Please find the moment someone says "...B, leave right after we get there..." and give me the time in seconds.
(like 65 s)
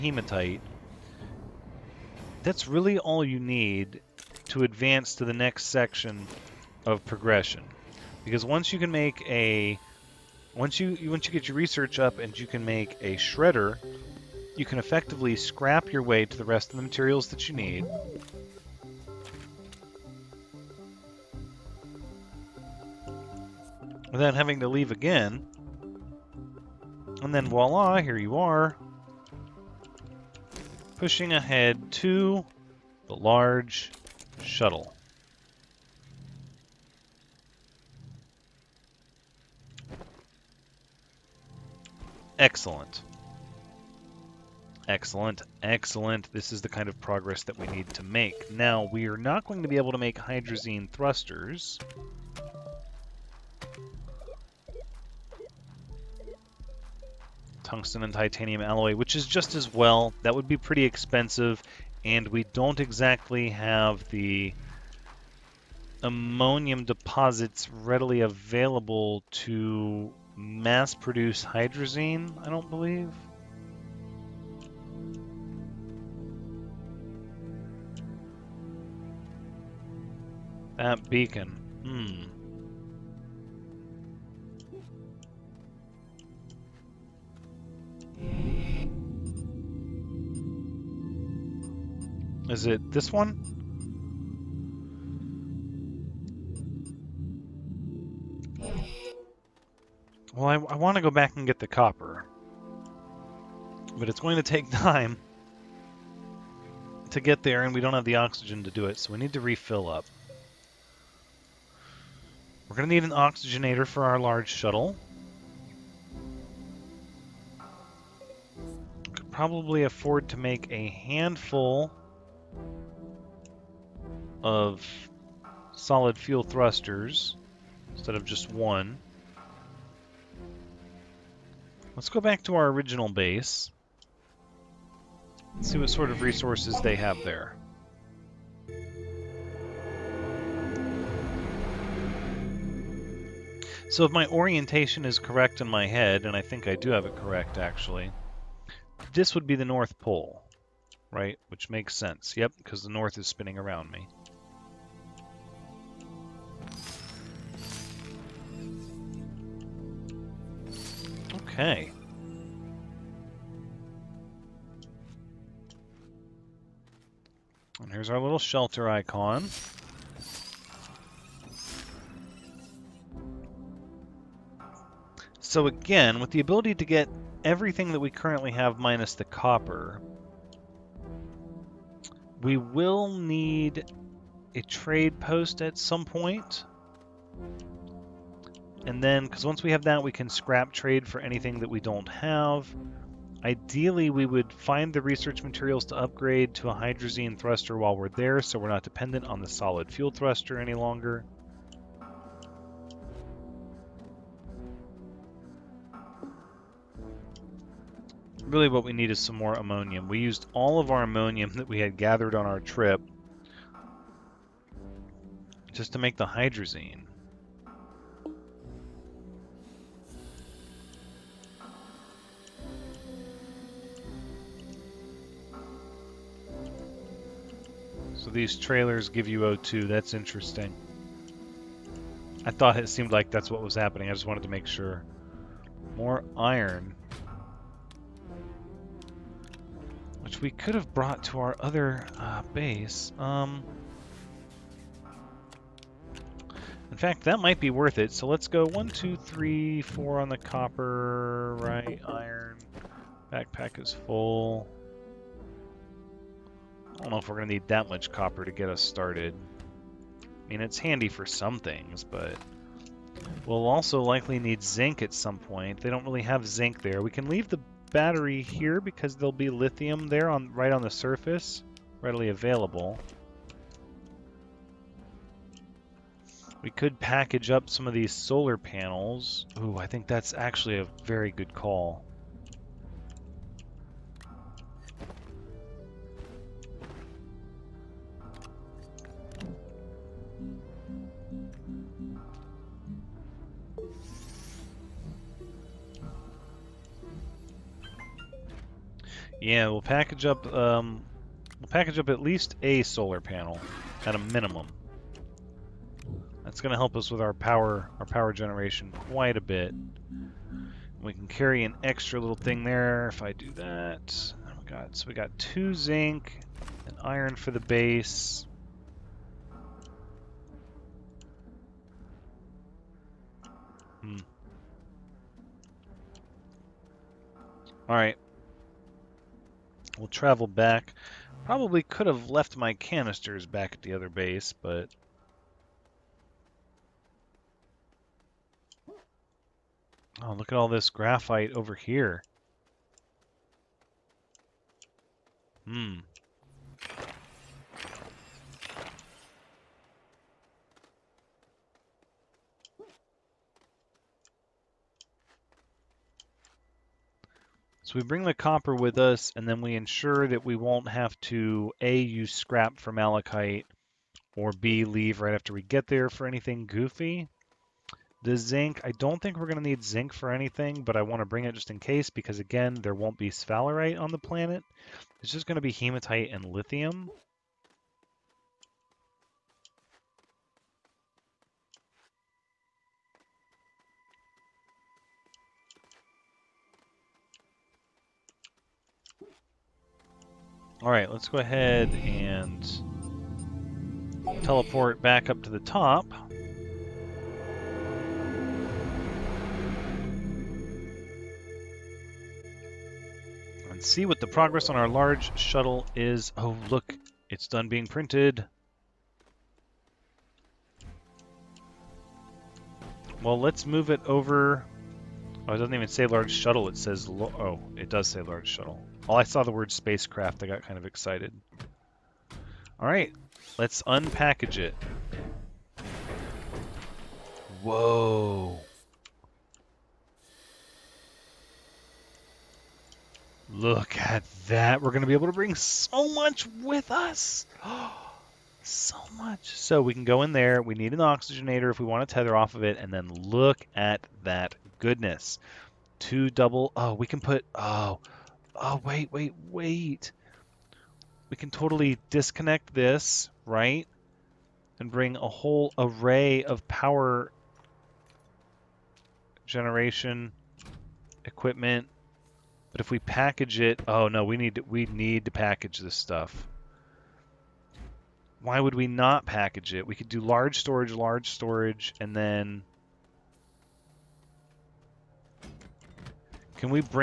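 364 s.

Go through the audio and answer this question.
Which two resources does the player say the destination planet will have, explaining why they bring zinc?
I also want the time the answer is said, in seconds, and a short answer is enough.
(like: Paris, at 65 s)
Hematite and lithium, at 375 s.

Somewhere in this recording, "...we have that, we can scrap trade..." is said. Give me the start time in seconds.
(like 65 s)
189 s.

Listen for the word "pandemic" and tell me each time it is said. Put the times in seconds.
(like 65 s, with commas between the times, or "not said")
not said.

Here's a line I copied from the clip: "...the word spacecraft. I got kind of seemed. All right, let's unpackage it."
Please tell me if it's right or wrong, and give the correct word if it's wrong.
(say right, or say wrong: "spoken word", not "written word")
wrong: "excited", not "seemed".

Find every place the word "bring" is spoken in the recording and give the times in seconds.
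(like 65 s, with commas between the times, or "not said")
358 s, 371 s, 435 s, 454 s.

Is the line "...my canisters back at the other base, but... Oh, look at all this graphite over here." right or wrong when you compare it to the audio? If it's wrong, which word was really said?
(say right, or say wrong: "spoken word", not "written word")
right.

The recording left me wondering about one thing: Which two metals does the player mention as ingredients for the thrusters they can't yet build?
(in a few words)
Tungsten and titanium.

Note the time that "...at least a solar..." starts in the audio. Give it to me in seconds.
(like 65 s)
302 s.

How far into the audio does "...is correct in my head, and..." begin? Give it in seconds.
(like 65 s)
145 s.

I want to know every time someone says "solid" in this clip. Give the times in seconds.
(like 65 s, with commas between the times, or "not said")
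125 s, 199 s.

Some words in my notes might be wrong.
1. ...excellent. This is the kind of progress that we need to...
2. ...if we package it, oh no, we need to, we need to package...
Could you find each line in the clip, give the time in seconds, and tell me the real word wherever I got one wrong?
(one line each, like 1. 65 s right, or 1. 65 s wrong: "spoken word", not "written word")
1. 45 s right
2. 462 s right.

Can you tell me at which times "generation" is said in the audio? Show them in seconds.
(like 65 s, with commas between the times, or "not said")
308 s, 459 s.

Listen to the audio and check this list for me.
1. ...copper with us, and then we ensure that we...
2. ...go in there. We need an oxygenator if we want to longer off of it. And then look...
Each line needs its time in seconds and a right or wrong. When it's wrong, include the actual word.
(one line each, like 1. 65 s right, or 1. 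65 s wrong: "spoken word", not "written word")
1. 358 s right
2. 440 s wrong: "tether", not "longer".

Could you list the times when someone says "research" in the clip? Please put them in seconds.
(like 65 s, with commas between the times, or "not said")
11 s, 195 s.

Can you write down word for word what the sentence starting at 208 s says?
Really what we need is some more ammonium.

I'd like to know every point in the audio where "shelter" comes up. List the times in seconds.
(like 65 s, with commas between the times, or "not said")
168 s.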